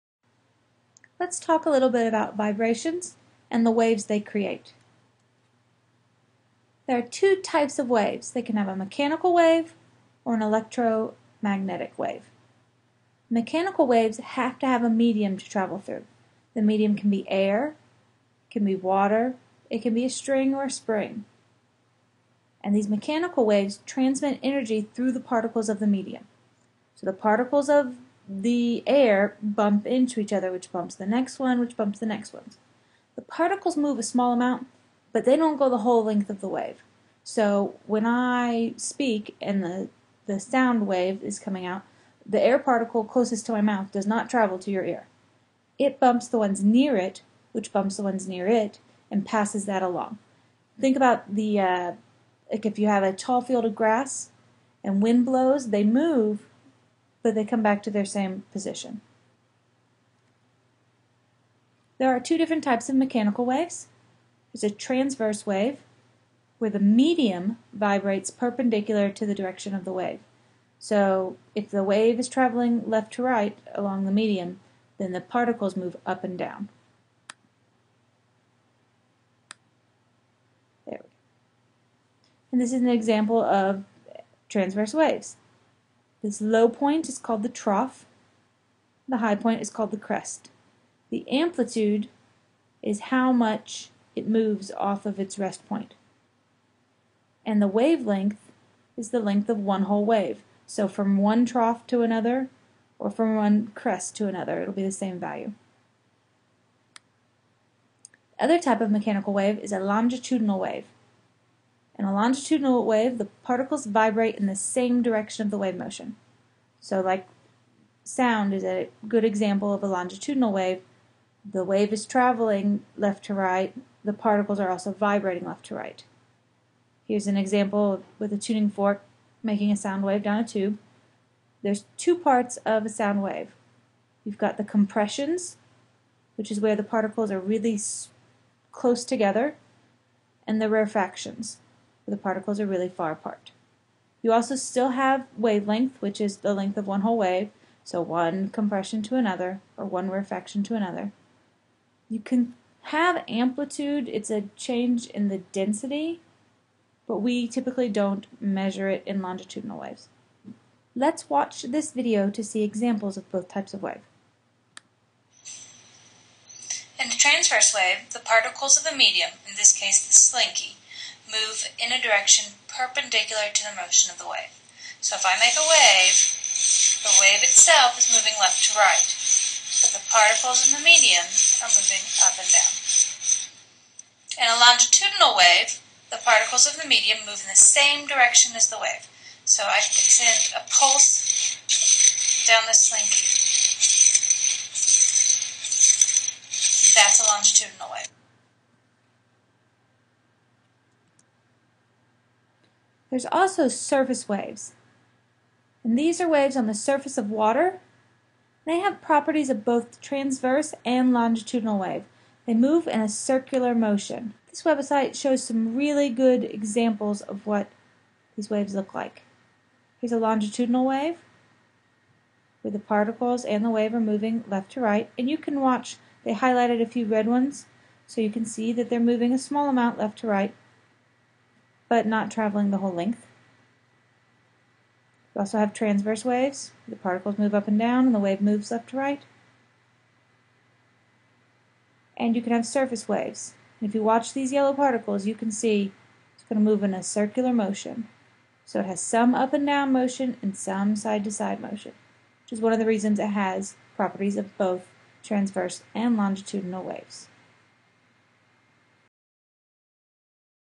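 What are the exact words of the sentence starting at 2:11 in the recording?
There's two parts of a sound wave.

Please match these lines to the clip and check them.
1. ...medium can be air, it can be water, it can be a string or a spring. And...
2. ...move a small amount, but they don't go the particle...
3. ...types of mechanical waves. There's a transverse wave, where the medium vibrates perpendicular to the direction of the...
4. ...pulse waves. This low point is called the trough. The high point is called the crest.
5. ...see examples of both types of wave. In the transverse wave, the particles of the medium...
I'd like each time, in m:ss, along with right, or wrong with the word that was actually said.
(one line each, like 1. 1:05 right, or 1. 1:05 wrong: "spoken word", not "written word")
1. 0:16 right
2. 0:33 wrong: "whole", not "particle"
3. 1:02 right
4. 1:24 wrong: "transverse", not "pulse"
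5. 2:42 right.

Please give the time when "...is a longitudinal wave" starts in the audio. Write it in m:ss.
1:49.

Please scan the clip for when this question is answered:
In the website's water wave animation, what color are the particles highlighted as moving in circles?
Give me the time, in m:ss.
4:04.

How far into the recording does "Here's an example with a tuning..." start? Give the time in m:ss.
2:07.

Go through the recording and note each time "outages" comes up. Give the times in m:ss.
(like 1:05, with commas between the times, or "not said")
not said.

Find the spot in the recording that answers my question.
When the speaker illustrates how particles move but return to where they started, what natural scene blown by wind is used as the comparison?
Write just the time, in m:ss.
0:53.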